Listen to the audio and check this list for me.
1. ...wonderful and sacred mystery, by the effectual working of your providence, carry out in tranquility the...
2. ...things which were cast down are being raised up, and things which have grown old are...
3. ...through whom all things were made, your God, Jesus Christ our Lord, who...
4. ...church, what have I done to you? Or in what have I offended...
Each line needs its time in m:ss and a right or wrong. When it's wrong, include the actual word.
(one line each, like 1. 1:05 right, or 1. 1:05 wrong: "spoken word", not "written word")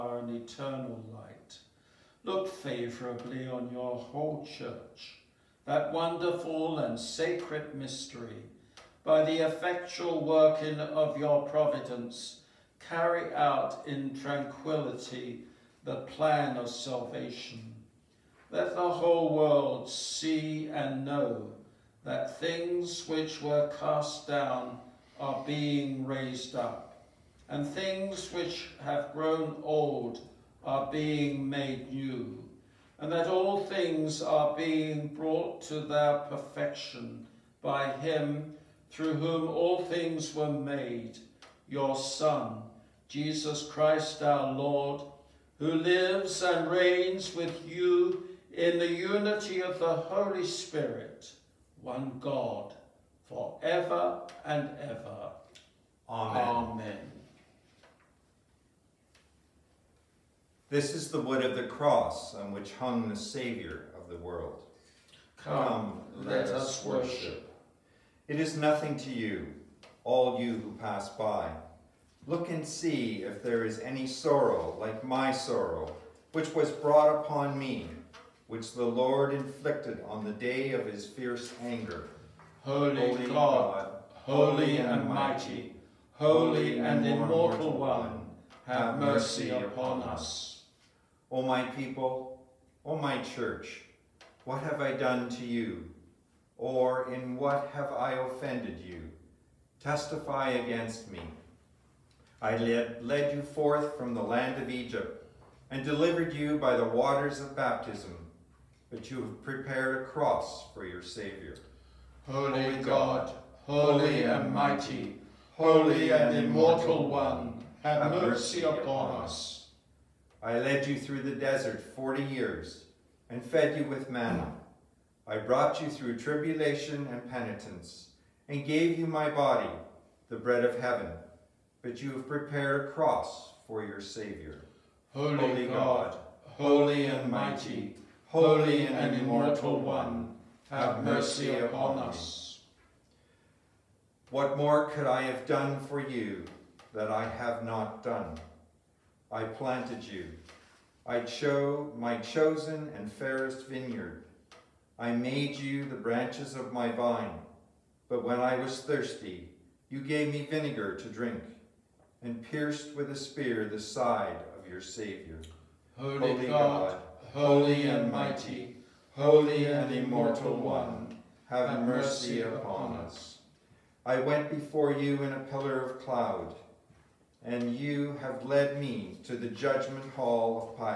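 1. 0:05 right
2. 0:22 right
3. 0:38 wrong: "Son", not "God"
4. 1:33 right.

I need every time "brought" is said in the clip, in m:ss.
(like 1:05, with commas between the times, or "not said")
0:35, 1:16, 2:05.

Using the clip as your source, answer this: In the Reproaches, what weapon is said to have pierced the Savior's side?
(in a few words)
a spear.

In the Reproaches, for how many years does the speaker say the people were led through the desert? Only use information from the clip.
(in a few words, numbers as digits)
40.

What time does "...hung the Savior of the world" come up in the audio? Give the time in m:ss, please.
1:02.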